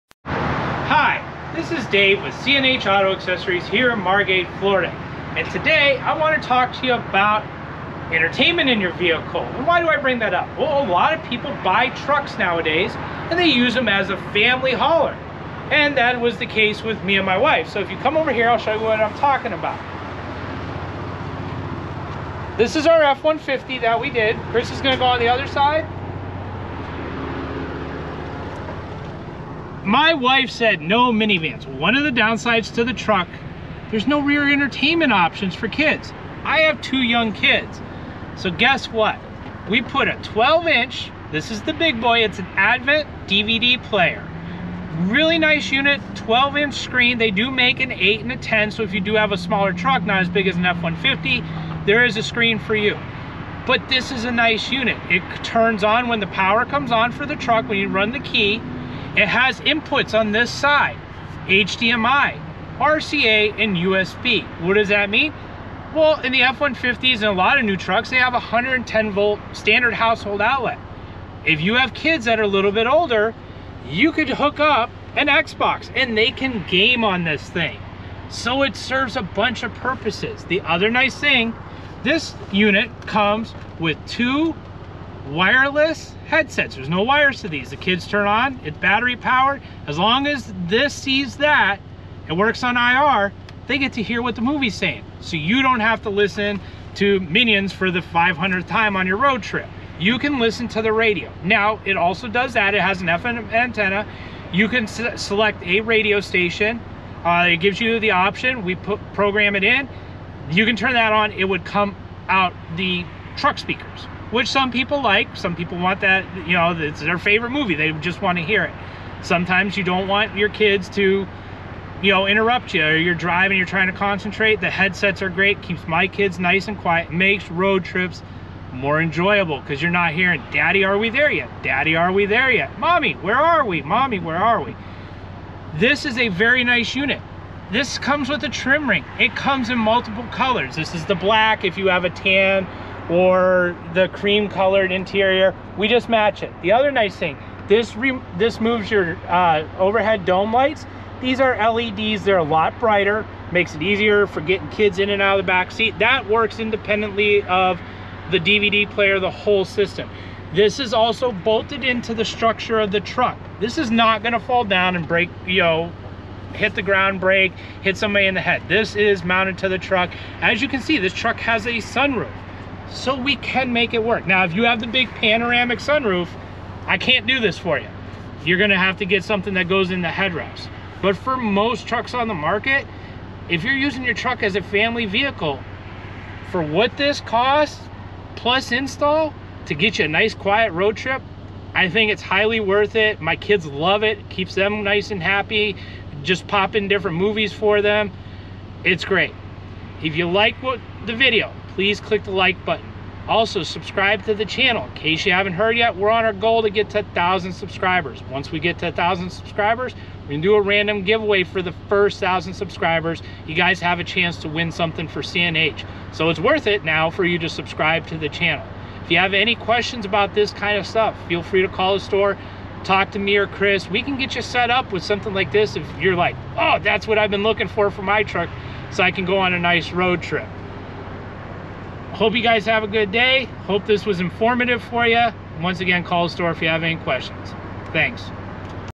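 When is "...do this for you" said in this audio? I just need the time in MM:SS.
02:57.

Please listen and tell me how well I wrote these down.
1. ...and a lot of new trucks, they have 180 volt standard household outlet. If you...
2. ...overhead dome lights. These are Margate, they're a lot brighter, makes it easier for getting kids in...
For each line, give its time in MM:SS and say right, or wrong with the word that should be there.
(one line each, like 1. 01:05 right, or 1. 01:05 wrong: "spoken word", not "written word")
1. 01:07 wrong: "110", not "180"
2. 02:29 wrong: "LEDs", not "Margate".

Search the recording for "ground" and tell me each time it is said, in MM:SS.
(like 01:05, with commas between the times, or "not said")
02:46.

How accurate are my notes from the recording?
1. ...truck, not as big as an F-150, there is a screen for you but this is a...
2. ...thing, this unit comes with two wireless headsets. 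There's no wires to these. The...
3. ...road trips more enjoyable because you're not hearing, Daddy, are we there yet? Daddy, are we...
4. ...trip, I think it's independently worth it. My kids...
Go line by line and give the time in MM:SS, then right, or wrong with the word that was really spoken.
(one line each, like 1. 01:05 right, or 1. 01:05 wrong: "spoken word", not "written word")
1. 00:49 right
2. 01:21 right
3. 02:07 right
4. 03:10 wrong: "highly", not "independently".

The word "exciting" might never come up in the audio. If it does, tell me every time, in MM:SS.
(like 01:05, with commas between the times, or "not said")
not said.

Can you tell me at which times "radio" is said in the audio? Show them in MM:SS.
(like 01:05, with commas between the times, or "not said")
01:40, 01:45.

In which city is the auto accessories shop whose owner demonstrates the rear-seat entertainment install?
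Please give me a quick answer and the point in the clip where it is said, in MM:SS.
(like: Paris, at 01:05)
Margate, at 00:03.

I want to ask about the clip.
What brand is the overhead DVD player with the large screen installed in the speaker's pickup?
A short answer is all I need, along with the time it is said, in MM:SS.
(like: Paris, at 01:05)
Advant, at 00:42.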